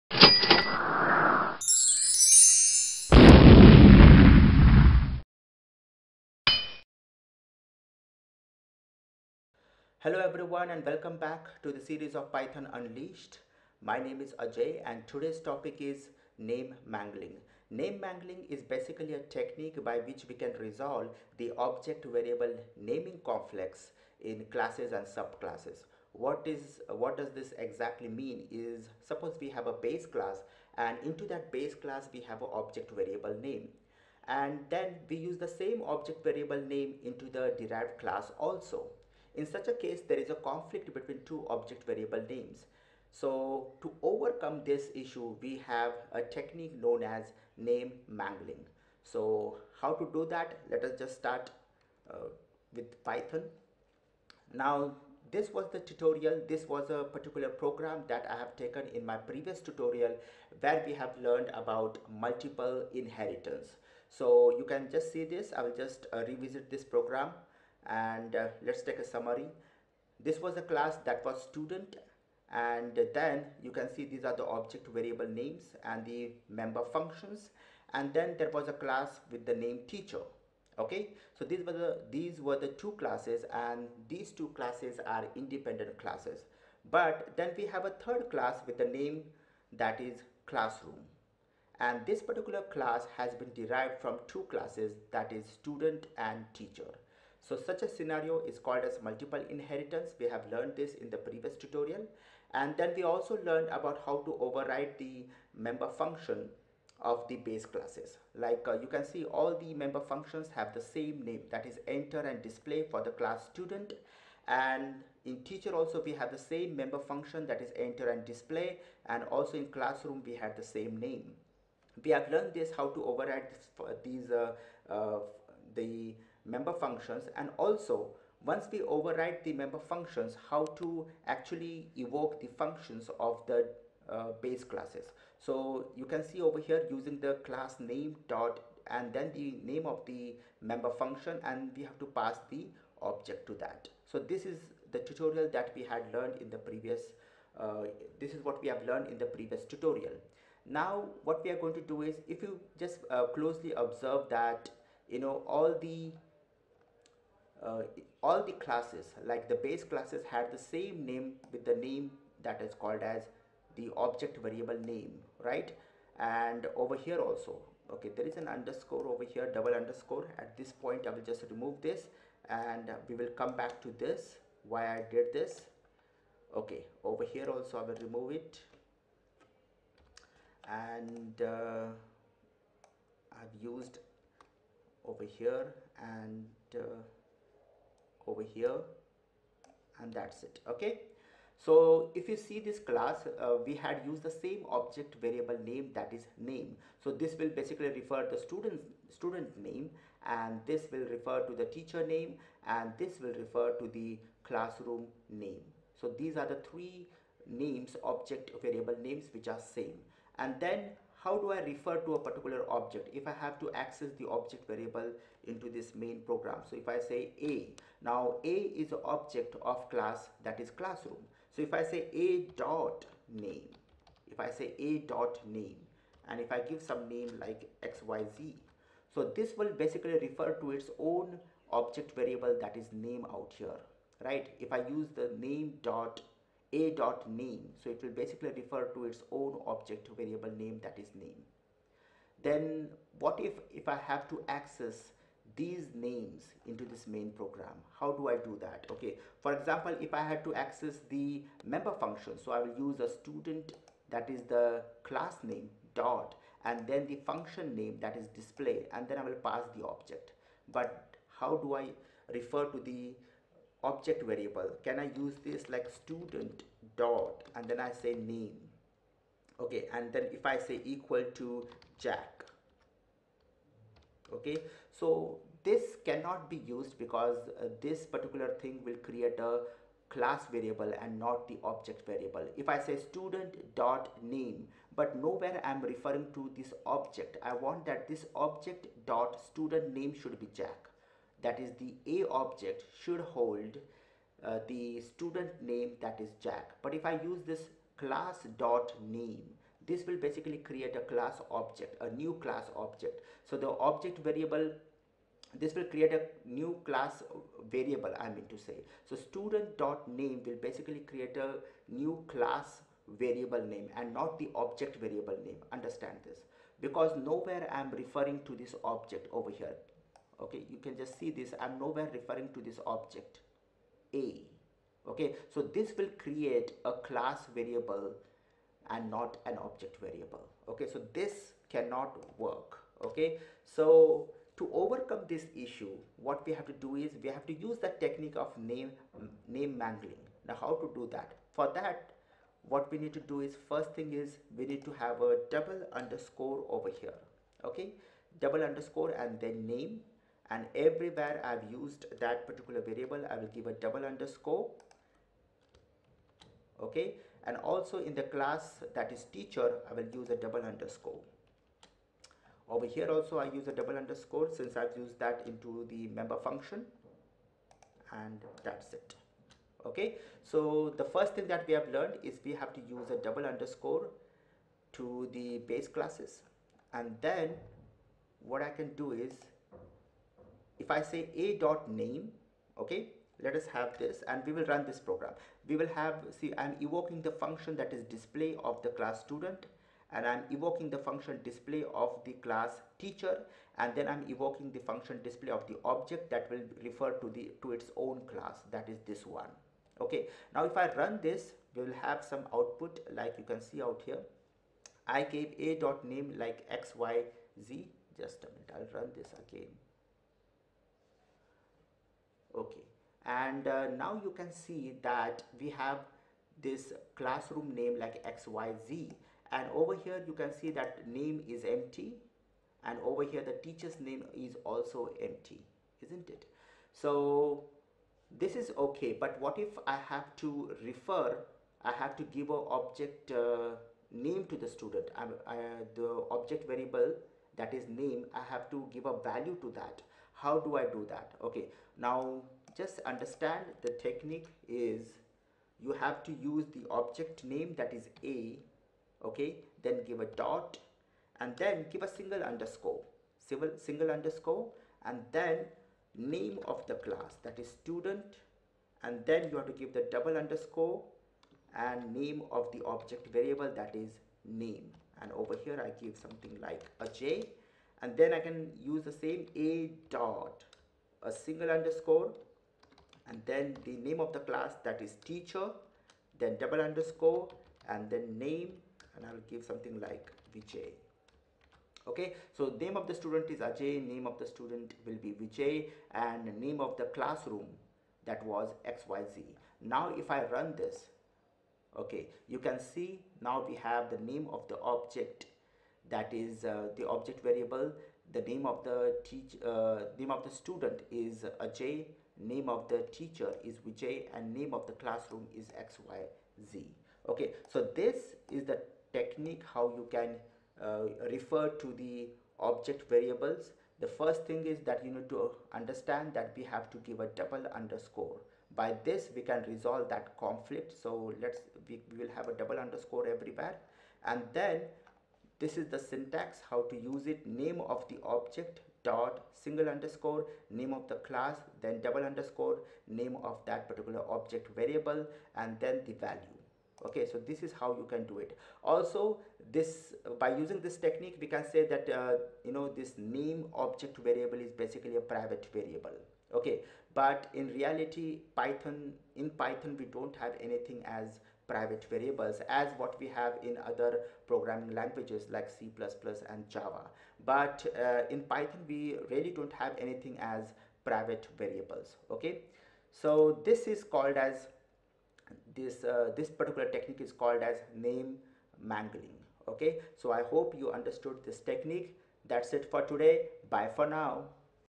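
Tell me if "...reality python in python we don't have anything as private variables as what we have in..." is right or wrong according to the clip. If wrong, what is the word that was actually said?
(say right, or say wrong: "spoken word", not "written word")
right.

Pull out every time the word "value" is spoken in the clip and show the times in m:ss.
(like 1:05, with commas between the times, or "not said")
7:19, 8:56.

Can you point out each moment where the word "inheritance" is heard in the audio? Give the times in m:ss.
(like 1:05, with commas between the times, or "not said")
1:02, 1:39.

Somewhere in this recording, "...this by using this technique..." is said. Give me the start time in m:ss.
8:59.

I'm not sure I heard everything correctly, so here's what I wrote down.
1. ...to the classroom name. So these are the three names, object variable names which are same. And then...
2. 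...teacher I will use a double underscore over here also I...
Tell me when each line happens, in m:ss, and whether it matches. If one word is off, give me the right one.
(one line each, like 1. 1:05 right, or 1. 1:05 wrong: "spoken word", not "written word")
1. 3:23 right
2. 5:59 right.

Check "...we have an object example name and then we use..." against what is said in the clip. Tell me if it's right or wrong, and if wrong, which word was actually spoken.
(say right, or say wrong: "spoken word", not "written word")
wrong: "variable", not "example".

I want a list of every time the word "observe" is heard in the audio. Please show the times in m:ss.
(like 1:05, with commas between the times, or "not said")
2:33.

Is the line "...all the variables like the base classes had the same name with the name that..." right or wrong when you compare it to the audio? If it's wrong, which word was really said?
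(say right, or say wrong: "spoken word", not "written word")
wrong: "classes", not "variables".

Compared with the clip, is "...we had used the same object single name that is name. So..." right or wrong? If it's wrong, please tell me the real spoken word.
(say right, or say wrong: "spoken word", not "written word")
wrong: "variable", not "single".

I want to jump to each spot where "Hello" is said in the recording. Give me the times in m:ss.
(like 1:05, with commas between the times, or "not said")
0:10.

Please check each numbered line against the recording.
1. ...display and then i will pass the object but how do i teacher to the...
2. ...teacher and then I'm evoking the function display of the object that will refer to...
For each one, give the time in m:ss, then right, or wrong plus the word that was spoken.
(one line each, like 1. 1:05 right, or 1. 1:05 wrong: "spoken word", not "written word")
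1. 4:18 wrong: "refer", not "teacher"
2. 6:33 right.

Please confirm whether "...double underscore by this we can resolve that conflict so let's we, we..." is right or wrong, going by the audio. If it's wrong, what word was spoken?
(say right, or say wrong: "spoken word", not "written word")
right.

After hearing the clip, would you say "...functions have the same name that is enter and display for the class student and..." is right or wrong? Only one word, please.
right.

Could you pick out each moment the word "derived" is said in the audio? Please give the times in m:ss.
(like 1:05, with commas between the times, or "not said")
0:37, 1:33.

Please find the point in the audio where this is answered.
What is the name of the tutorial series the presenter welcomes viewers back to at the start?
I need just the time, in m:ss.
0:12.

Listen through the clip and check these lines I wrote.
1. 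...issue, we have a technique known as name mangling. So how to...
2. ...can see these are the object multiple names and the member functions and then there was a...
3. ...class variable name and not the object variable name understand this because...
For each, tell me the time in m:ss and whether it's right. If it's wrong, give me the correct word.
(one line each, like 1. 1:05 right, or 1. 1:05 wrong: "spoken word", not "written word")
1. 0:44 right
2. 1:13 wrong: "variable", not "multiple"
3. 5:12 right.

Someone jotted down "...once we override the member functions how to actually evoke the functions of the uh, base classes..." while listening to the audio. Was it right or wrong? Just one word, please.
right.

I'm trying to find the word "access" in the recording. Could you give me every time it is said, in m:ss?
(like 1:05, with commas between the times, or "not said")
3:33, 4:04, 4:10.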